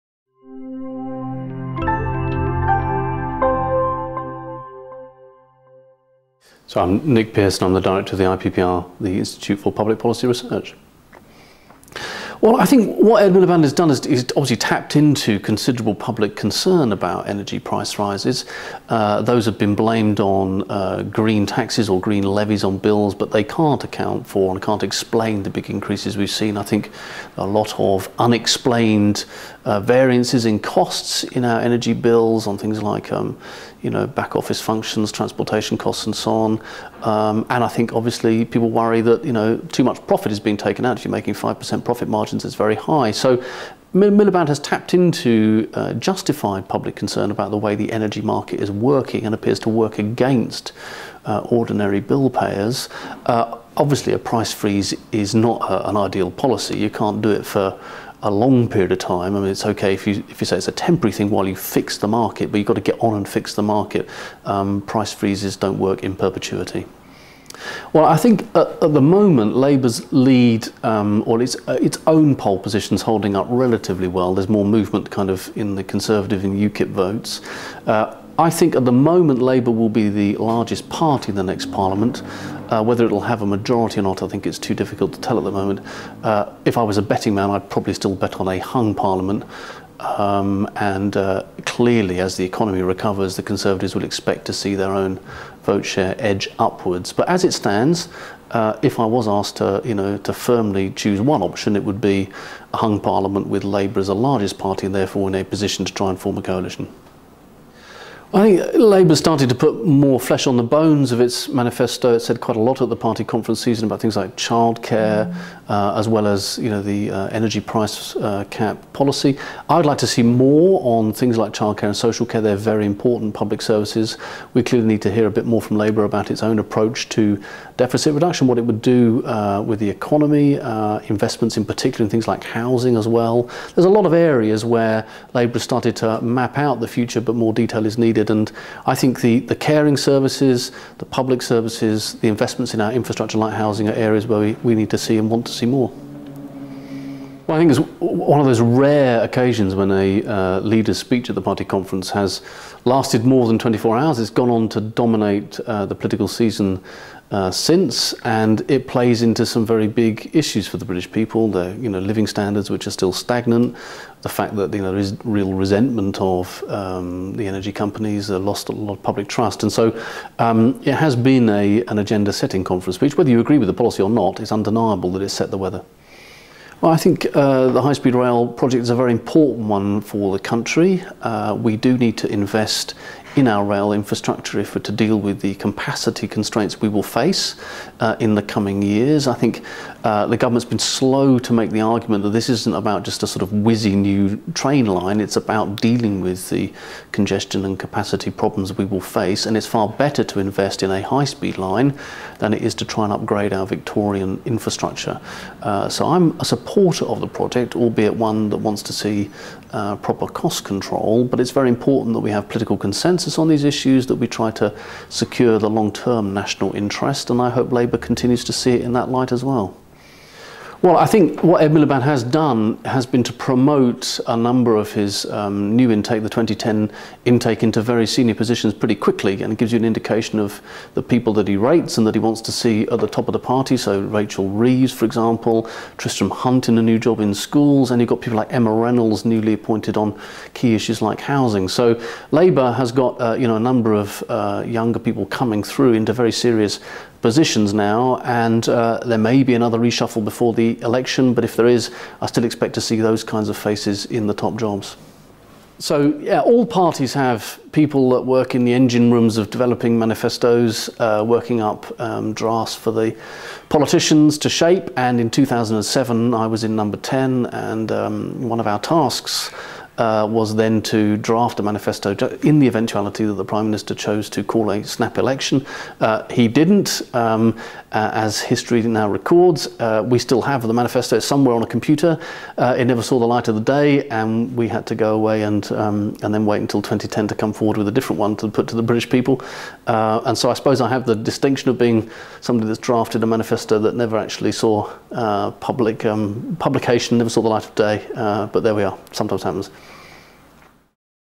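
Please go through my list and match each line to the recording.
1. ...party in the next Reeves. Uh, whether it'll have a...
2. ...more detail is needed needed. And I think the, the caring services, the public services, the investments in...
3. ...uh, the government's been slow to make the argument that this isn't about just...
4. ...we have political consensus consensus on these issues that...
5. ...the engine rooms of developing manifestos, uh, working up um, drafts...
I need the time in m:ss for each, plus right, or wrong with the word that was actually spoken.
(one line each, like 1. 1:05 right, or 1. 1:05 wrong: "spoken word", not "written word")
1. 1:20 wrong: "Parliament", not "Reeves"
2. 2:17 right
3. 3:10 right
4. 3:32 right
5. 4:18 right.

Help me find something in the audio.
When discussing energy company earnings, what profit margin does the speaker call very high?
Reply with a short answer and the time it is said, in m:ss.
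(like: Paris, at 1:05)
5%, at 0:41.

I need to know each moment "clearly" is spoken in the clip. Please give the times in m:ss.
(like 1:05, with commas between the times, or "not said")
1:31, 2:04.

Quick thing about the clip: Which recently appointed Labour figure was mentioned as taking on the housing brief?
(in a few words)
Emma Reynolds.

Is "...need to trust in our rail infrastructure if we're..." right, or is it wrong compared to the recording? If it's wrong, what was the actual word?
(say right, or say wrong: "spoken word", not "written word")
wrong: "invest", not "trust".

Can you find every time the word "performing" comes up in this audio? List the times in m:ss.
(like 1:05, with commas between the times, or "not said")
not said.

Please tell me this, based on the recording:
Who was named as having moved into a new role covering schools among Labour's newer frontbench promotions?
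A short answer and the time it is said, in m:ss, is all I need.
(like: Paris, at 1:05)
Tristram Hunt, at 3:55.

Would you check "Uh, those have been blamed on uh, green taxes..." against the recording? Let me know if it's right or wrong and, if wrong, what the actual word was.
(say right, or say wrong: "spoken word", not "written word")
right.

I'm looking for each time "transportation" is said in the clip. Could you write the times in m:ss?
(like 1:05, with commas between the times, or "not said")
0:35.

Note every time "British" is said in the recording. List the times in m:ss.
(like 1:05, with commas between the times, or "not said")
2:40, 4:48.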